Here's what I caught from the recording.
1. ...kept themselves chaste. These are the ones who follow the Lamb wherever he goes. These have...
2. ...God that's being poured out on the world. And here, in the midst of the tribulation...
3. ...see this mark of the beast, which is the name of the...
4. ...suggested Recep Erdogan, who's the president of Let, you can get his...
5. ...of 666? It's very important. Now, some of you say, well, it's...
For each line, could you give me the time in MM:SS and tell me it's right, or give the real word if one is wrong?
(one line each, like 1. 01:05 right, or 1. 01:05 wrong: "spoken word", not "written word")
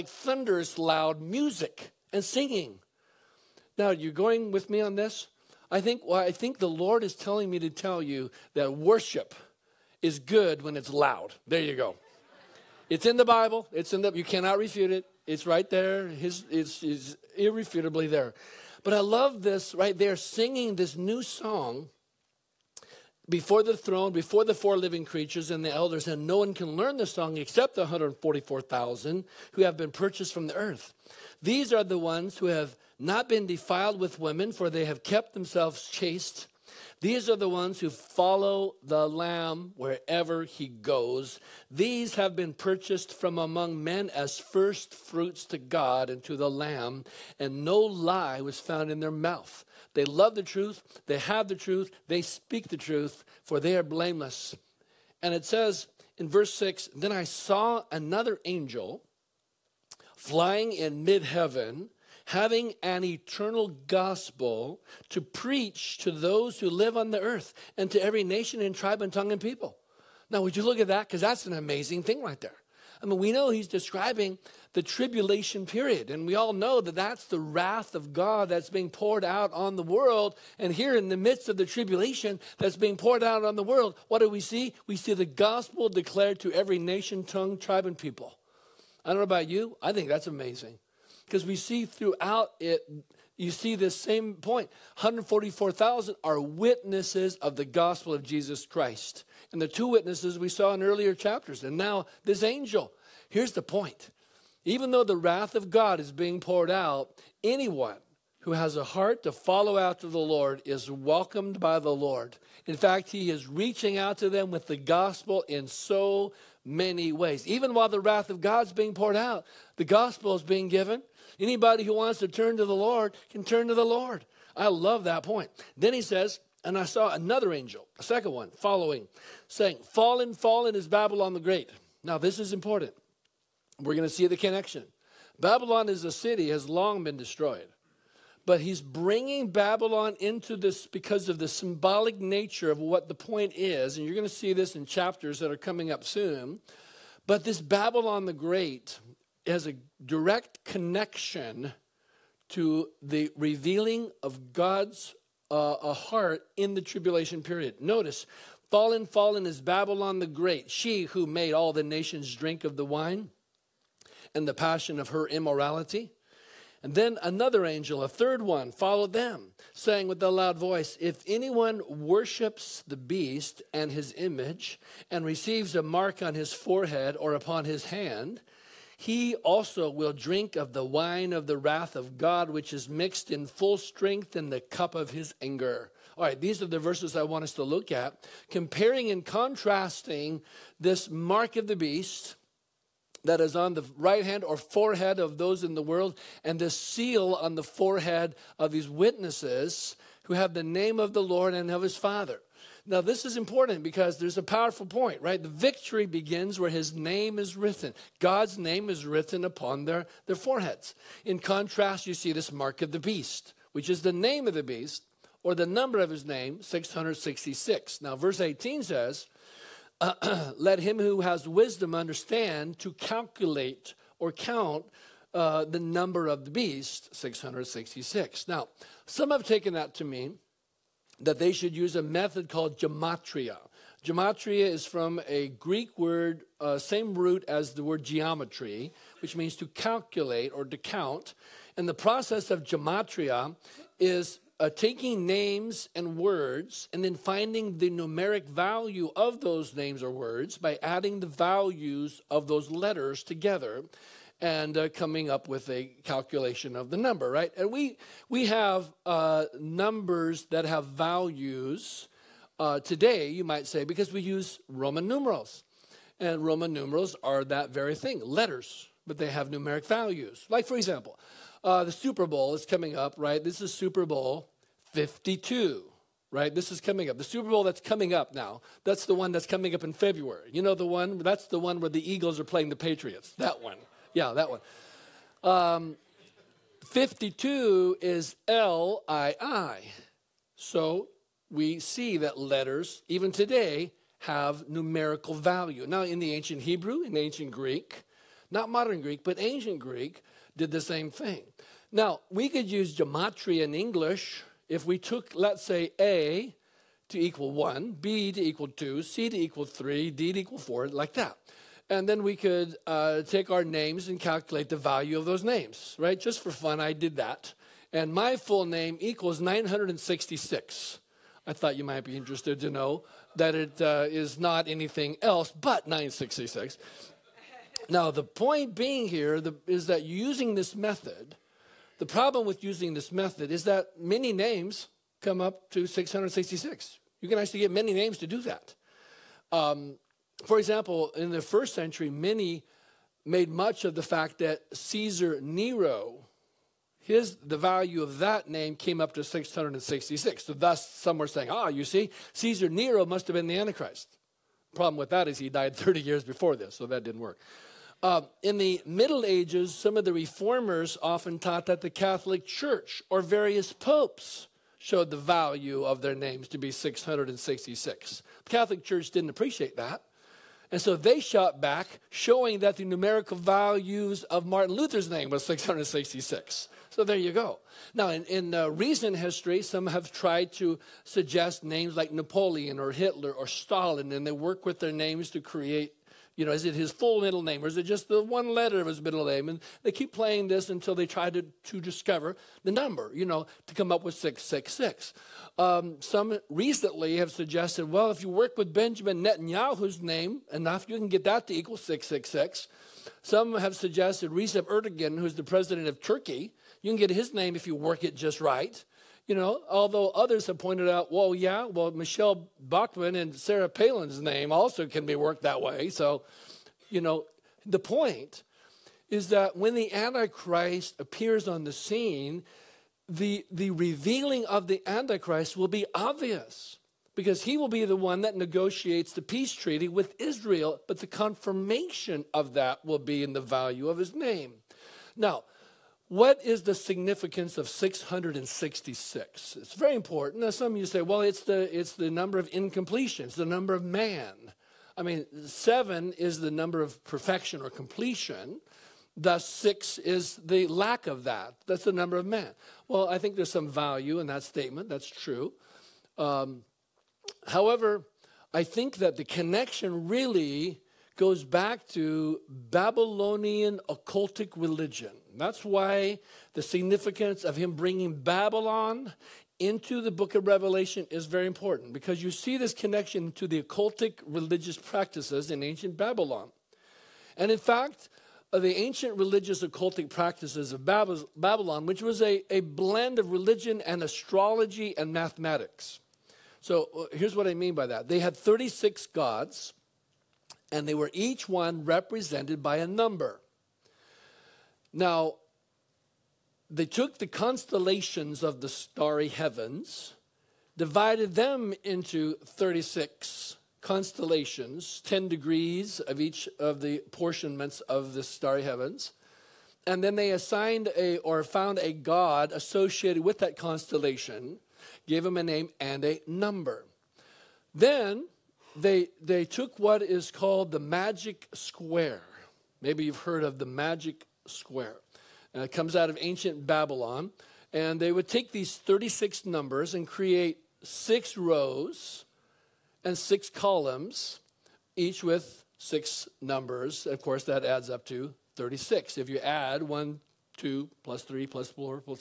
1. 00:35 right
2. 01:18 right
3. 03:32 right
4. 06:43 wrong: "Turkey", not "Let"
5. 07:17 right.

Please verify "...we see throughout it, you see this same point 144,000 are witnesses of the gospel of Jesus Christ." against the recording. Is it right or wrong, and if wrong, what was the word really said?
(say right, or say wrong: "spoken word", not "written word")
right.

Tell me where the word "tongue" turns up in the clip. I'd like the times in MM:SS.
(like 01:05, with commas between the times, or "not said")
01:09, 01:27.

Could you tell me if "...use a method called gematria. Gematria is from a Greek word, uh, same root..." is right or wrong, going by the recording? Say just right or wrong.
right.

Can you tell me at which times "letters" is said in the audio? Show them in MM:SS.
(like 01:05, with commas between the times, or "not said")
04:12, 04:28, 04:52, 06:28.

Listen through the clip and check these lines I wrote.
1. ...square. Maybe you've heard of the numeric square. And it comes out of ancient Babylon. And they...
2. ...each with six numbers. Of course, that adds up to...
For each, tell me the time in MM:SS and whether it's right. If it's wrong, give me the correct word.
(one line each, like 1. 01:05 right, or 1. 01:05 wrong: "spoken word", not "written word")
1. 08:41 wrong: "magic", not "numeric"
2. 08:54 right.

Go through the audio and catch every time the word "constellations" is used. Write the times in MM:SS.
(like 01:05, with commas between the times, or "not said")
08:17, 08:23, 08:33.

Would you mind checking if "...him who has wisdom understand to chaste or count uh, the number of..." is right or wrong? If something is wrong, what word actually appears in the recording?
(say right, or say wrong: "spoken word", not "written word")
wrong: "calculate", not "chaste".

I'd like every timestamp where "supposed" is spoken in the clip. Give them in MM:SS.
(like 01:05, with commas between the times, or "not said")
not said.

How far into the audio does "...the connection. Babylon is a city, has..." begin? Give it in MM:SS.
02:14.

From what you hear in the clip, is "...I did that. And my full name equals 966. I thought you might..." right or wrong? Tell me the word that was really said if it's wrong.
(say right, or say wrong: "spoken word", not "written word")
right.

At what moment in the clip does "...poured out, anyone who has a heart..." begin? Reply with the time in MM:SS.
01:46.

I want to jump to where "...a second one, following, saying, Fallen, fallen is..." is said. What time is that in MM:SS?
02:07.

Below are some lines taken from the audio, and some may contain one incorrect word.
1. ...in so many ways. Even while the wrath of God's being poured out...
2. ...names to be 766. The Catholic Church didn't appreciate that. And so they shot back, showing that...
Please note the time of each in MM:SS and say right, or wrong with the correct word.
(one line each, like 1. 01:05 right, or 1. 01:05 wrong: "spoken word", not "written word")
1. 01:55 right
2. 06:06 wrong: "666", not "766".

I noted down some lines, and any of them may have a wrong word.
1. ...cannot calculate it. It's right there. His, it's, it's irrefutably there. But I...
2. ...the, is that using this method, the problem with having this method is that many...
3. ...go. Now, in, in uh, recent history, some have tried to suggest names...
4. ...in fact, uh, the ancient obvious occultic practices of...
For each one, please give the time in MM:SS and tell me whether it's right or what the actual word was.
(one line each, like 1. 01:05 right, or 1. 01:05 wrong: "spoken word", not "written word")
1. 00:14 wrong: "refute", not "calculate"
2. 05:29 wrong: "using", not "having"
3. 06:17 right
4. 07:57 wrong: "religious", not "obvious".